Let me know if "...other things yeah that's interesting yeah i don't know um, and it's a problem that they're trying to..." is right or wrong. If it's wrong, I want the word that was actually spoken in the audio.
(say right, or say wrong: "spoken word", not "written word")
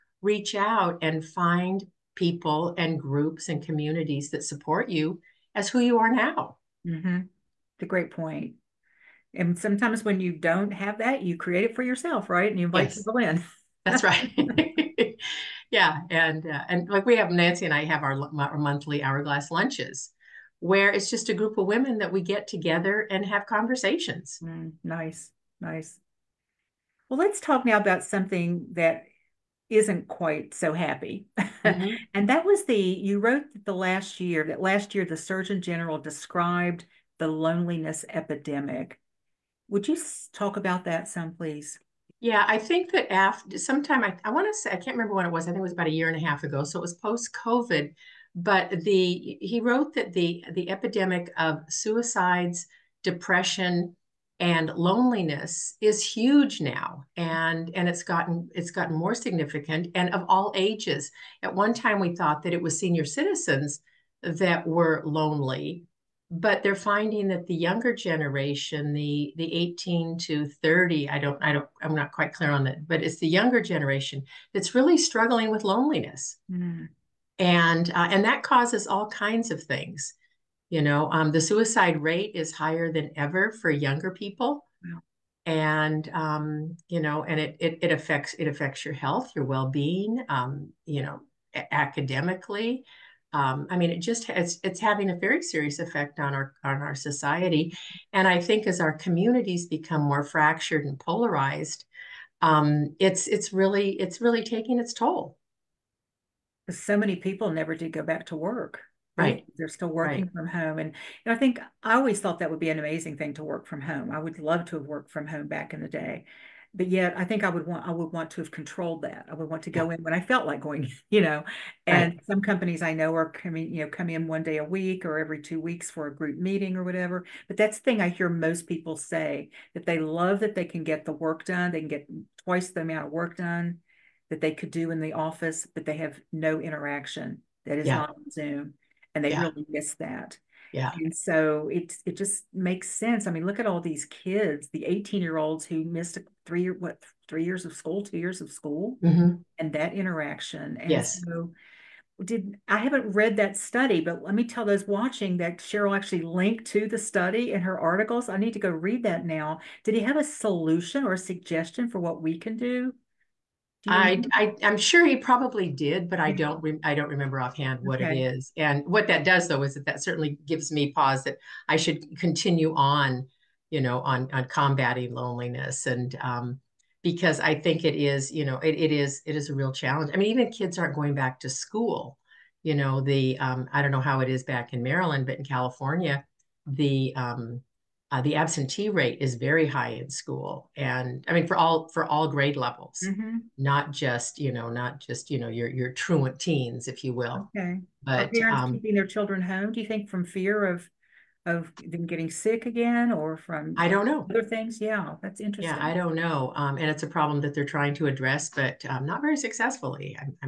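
right.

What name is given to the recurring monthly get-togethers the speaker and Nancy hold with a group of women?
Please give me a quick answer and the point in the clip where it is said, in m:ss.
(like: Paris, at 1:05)
hourglass lunches, at 0:19.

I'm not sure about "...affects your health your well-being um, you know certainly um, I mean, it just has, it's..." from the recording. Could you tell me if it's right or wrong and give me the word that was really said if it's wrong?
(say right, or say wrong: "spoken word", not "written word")
wrong: "academically", not "certainly".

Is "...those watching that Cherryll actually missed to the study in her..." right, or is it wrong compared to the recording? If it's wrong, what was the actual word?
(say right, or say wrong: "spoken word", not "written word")
wrong: "linked", not "missed".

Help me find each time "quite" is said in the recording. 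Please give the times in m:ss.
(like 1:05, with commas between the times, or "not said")
0:30, 1:12.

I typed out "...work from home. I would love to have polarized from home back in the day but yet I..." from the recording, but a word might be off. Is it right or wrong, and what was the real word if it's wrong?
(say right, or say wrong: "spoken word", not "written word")
wrong: "worked", not "polarized".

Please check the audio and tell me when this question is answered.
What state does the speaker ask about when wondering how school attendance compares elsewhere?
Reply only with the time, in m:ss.
3:04.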